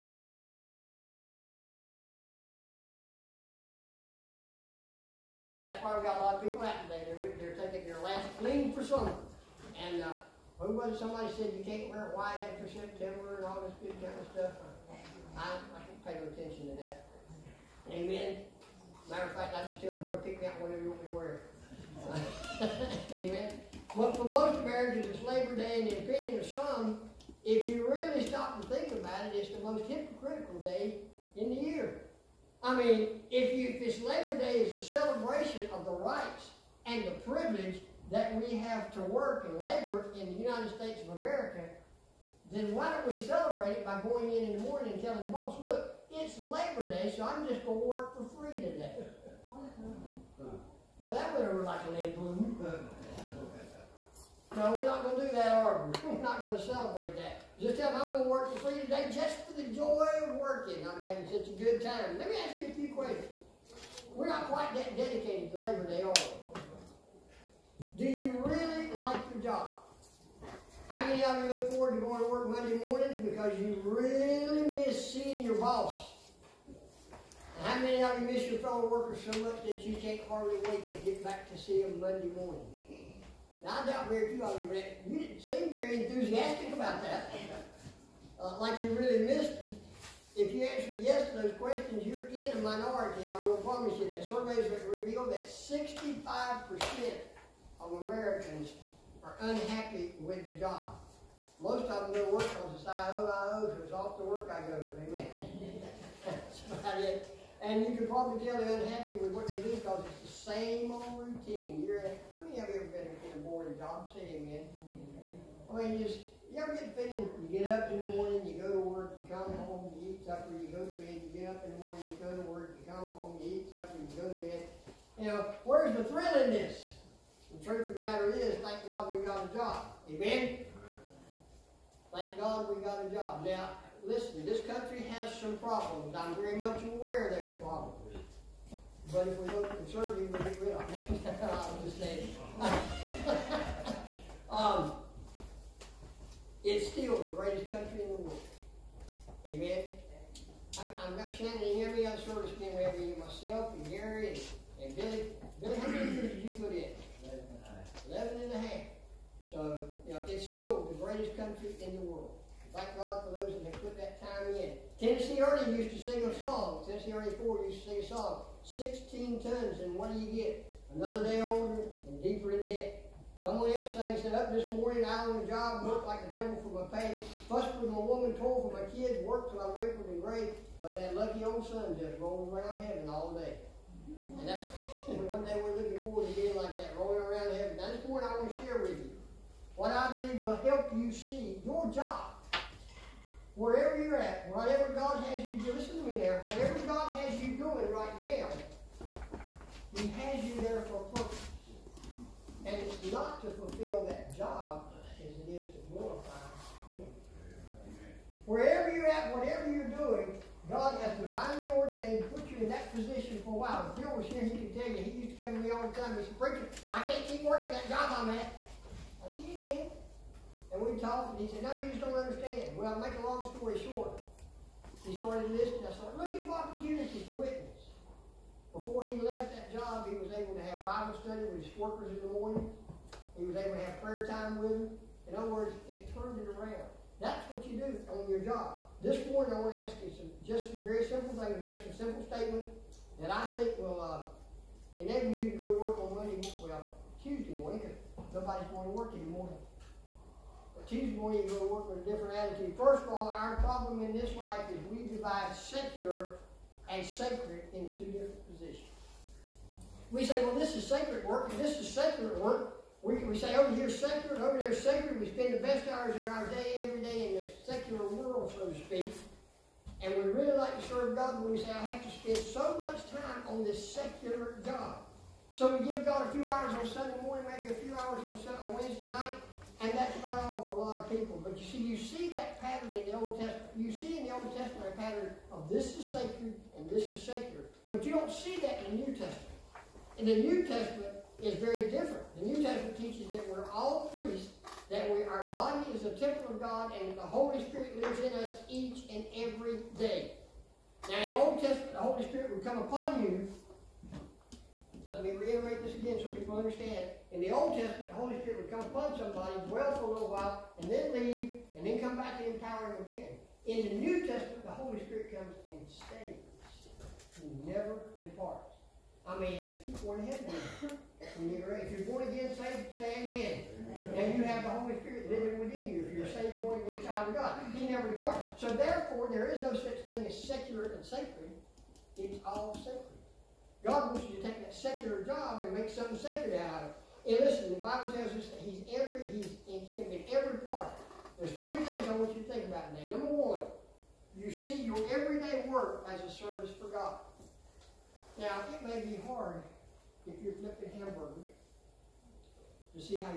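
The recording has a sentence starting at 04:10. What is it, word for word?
Tuesday morning you go to work with a different attitude.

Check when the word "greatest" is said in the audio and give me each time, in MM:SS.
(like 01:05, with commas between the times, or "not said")
02:27, 02:41.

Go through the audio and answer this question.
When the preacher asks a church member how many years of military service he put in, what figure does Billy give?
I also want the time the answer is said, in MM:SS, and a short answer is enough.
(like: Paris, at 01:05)
11.5, at 02:38.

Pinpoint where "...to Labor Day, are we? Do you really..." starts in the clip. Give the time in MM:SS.
01:05.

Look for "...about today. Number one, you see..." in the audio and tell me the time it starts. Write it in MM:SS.
05:42.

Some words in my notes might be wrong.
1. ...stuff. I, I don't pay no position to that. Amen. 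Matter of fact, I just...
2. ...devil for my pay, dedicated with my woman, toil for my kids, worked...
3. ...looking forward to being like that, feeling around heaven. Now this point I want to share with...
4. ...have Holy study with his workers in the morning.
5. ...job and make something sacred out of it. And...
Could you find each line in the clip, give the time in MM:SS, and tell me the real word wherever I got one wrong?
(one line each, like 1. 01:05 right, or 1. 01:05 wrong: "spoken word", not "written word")
1. 00:14 wrong: "attention", not "position"
2. 02:56 wrong: "fussed", not "dedicated"
3. 03:05 wrong: "rolling", not "feeling"
4. 03:50 wrong: "Bible", not "Holy"
5. 05:35 right.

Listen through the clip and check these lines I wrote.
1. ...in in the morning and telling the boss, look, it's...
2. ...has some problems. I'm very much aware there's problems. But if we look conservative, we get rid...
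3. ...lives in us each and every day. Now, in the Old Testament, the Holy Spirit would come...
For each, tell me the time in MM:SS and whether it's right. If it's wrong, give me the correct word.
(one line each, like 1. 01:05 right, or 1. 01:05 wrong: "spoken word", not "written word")
1. 00:44 right
2. 02:15 right
3. 04:57 right.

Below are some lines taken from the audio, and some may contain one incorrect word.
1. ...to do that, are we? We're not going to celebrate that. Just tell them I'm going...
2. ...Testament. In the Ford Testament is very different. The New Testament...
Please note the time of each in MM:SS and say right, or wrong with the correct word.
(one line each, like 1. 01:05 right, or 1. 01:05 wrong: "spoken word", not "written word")
1. 00:55 right
2. 04:49 wrong: "New", not "Ford".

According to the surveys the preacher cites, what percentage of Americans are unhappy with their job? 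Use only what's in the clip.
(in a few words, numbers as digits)
65%.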